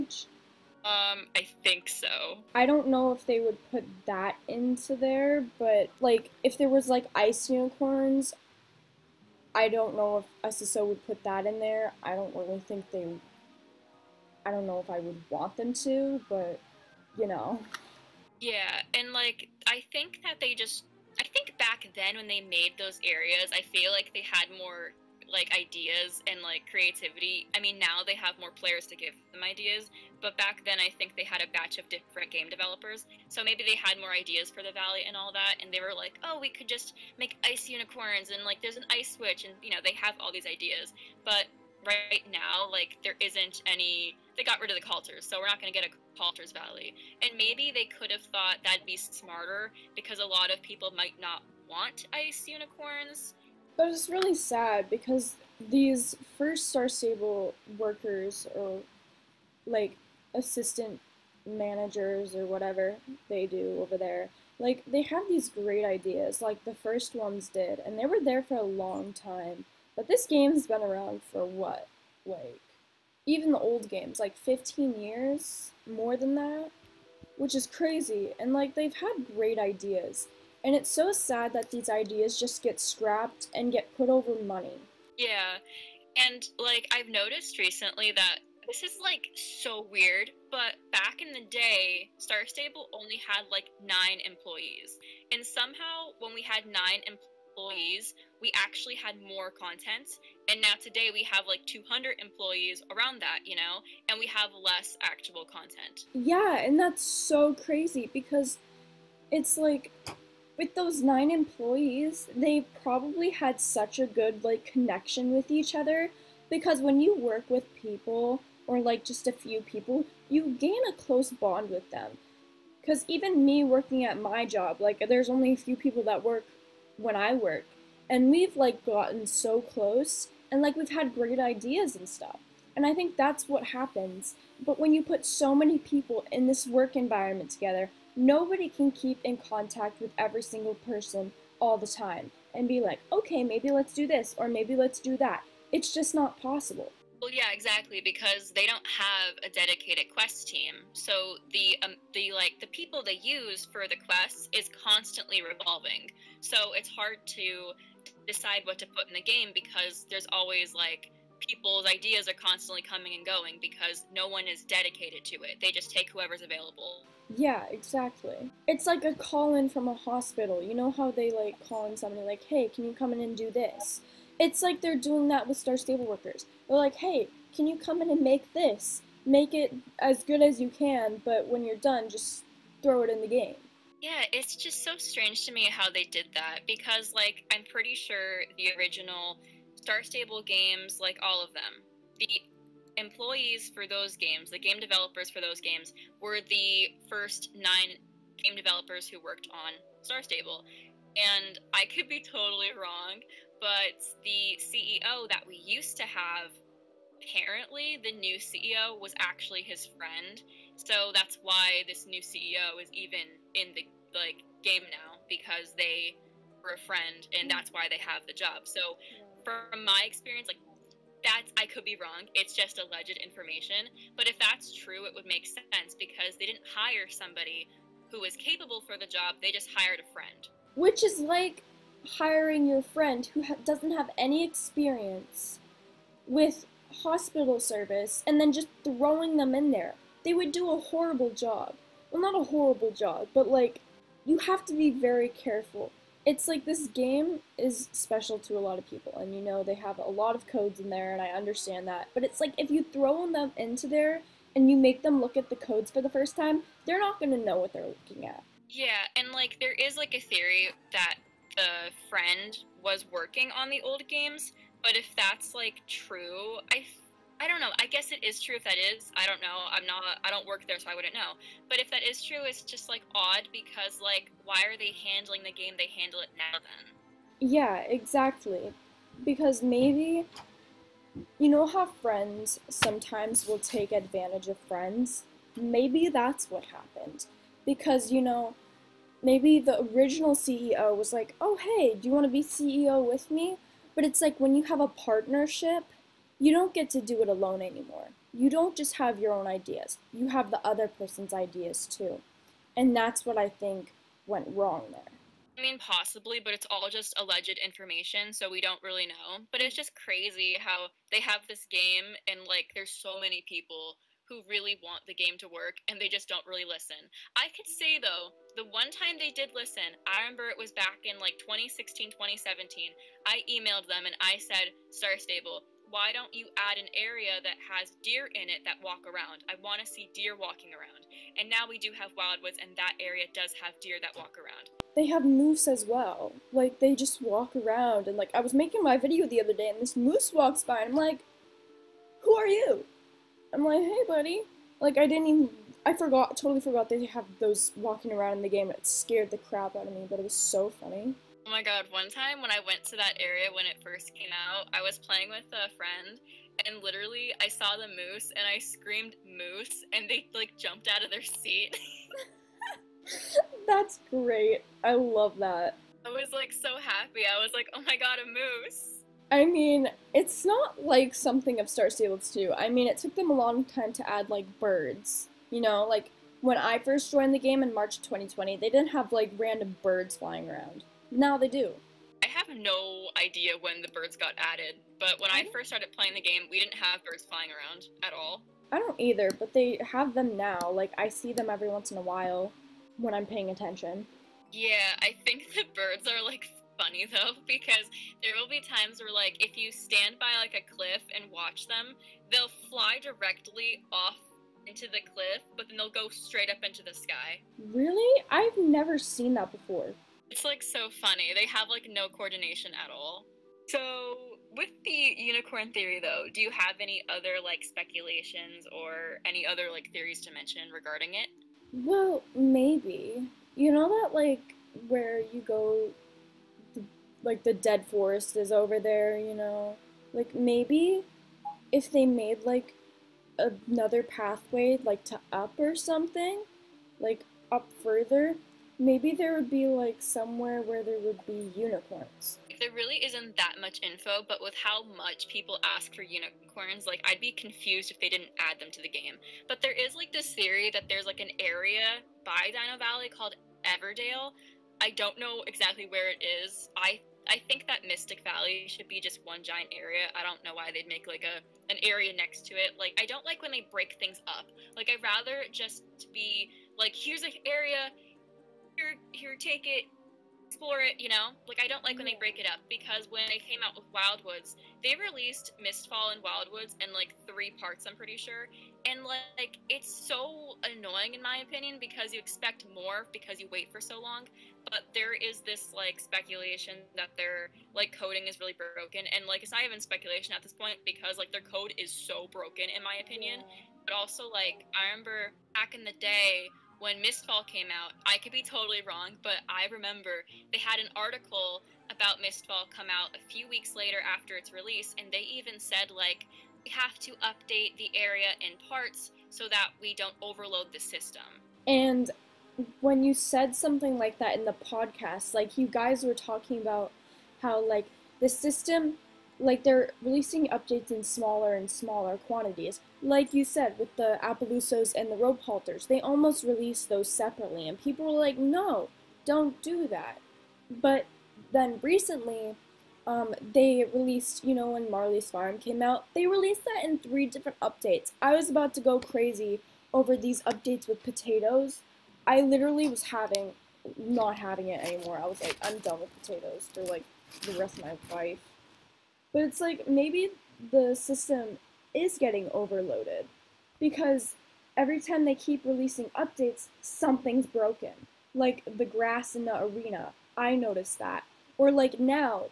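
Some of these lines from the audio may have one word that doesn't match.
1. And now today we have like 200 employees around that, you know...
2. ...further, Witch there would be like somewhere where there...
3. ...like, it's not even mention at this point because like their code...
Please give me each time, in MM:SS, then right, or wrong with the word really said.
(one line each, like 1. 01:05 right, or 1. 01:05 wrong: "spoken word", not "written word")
1. 01:40 right
2. 07:17 wrong: "Maybe", not "Witch"
3. 08:09 wrong: "speculation", not "mention".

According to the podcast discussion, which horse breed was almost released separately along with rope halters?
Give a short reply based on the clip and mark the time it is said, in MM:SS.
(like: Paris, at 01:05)
Appaloosas, at 08:44.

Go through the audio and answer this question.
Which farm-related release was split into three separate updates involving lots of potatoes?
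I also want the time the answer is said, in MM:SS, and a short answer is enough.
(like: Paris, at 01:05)
Marley's Farm, at 08:54.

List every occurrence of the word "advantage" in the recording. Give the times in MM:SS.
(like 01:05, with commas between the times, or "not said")
04:43.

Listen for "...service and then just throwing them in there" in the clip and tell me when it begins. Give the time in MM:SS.
03:57.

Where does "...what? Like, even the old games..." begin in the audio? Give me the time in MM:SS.
01:11.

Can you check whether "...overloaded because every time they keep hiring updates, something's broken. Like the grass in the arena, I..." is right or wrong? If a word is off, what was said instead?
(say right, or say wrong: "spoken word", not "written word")
wrong: "releasing", not "hiring".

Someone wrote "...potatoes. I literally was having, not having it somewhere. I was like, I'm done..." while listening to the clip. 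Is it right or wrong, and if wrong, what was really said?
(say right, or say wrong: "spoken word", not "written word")
wrong: "anymore", not "somewhere".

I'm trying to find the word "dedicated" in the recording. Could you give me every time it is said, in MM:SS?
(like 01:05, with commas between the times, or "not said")
02:29, 02:44.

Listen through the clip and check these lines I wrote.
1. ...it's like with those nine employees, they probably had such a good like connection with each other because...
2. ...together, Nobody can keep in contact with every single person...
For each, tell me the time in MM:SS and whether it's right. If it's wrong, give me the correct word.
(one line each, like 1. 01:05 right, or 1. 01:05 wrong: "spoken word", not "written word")
1. 01:49 right
2. 02:17 right.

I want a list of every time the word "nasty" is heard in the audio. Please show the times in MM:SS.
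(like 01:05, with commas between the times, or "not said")
not said.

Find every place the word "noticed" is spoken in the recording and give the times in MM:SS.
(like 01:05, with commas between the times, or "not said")
01:27, 09:20.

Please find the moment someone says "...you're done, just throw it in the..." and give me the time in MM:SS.
03:01.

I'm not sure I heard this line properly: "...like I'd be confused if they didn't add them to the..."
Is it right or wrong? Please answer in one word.
right.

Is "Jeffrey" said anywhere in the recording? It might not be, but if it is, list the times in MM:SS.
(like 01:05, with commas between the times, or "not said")
not said.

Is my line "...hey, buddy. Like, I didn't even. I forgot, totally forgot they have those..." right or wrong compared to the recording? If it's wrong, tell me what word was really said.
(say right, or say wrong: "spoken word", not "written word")
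right.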